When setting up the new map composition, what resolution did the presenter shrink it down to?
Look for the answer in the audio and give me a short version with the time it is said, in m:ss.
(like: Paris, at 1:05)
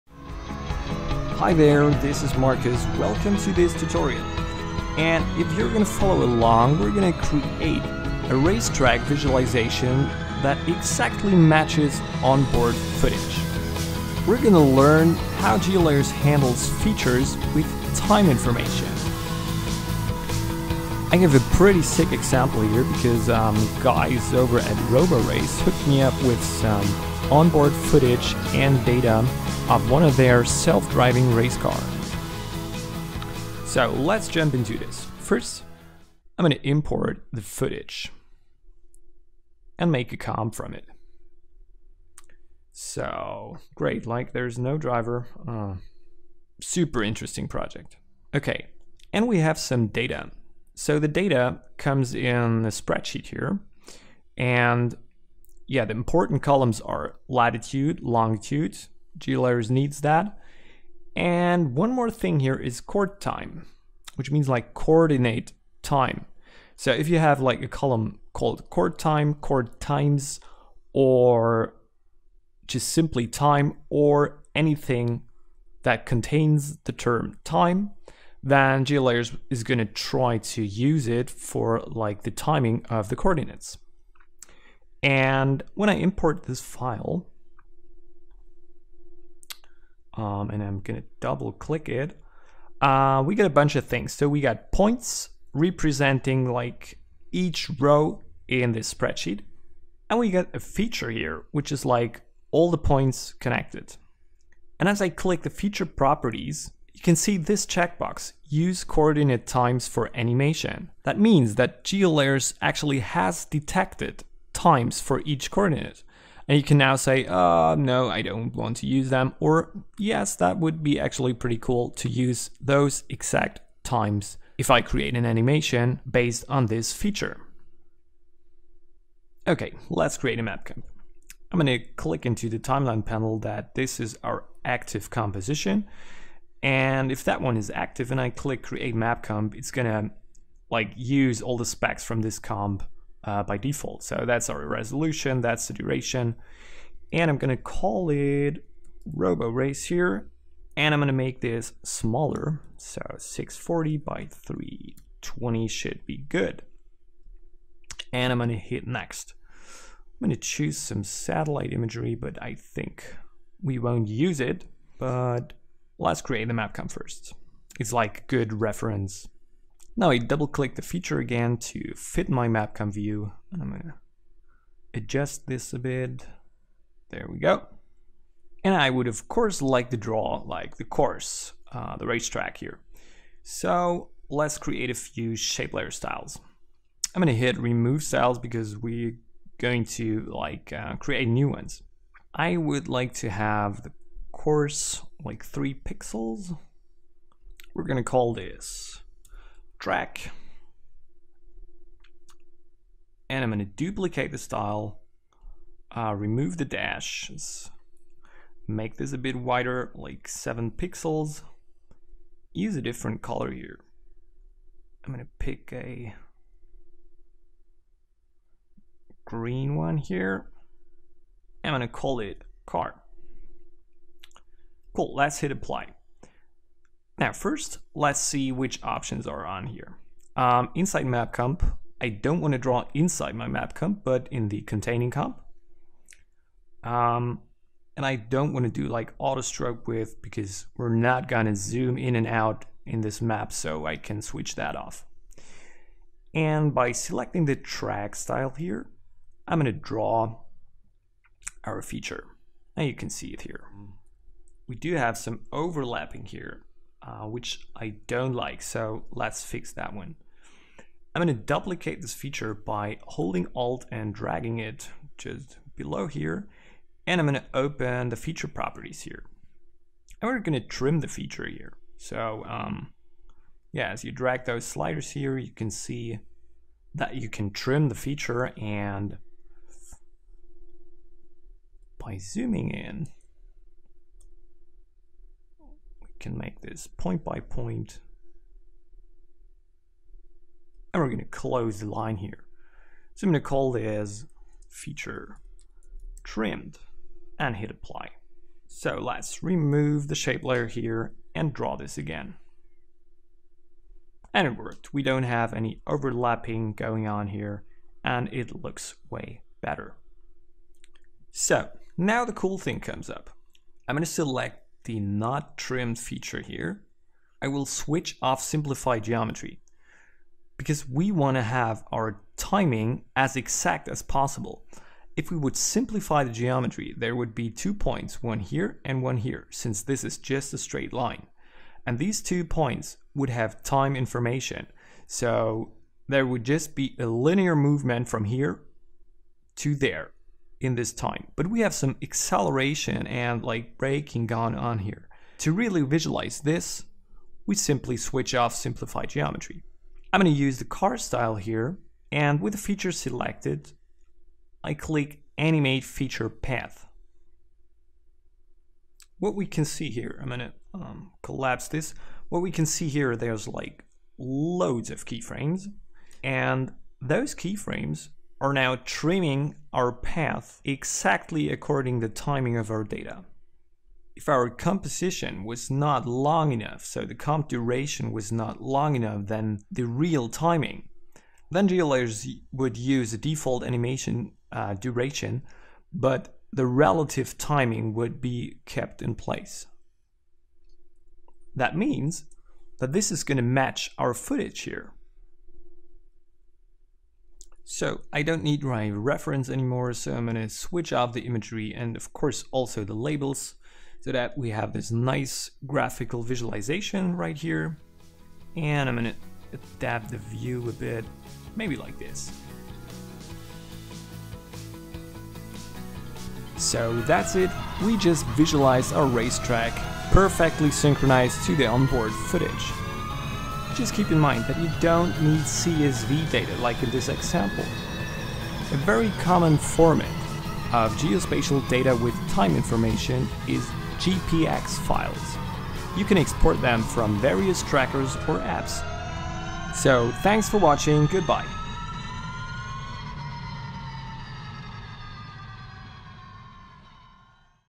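640 by 320, at 2:33.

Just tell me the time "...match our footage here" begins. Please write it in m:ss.
6:33.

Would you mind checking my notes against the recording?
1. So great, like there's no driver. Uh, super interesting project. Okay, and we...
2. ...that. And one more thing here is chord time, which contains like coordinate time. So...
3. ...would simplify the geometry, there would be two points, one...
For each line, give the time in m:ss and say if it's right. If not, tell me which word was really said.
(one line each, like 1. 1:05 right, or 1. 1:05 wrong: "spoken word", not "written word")
1. 0:42 right
2. 1:00 wrong: "means", not "contains"
3. 5:25 right.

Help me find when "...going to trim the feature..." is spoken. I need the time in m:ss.
4:30.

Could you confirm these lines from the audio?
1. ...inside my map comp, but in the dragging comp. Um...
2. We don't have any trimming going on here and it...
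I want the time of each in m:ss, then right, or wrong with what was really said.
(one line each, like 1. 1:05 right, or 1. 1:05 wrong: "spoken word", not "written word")
1. 3:52 wrong: "containing", not "dragging"
2. 5:04 wrong: "overlapping", not "trimming".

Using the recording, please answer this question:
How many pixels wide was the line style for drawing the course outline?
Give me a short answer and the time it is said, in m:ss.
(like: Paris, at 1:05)
3, at 3:15.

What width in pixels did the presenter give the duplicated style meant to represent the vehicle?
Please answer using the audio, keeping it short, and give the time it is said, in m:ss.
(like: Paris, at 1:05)
7, at 3:30.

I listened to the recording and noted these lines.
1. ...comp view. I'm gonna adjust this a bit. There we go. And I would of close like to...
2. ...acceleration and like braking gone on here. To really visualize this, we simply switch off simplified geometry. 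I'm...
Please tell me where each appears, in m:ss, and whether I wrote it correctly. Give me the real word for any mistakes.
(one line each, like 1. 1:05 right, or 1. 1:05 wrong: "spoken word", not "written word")
1. 2:52 wrong: "course", not "close"
2. 5:42 right.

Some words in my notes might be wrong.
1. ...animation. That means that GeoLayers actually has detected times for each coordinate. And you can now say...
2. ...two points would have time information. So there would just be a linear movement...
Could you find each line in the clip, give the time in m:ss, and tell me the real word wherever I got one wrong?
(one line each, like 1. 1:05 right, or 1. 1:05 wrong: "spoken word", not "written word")
1. 1:50 right
2. 5:32 right.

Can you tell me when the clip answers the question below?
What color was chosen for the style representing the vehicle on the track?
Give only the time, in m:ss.
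3:39.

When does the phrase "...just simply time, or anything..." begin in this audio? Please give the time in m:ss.
1:12.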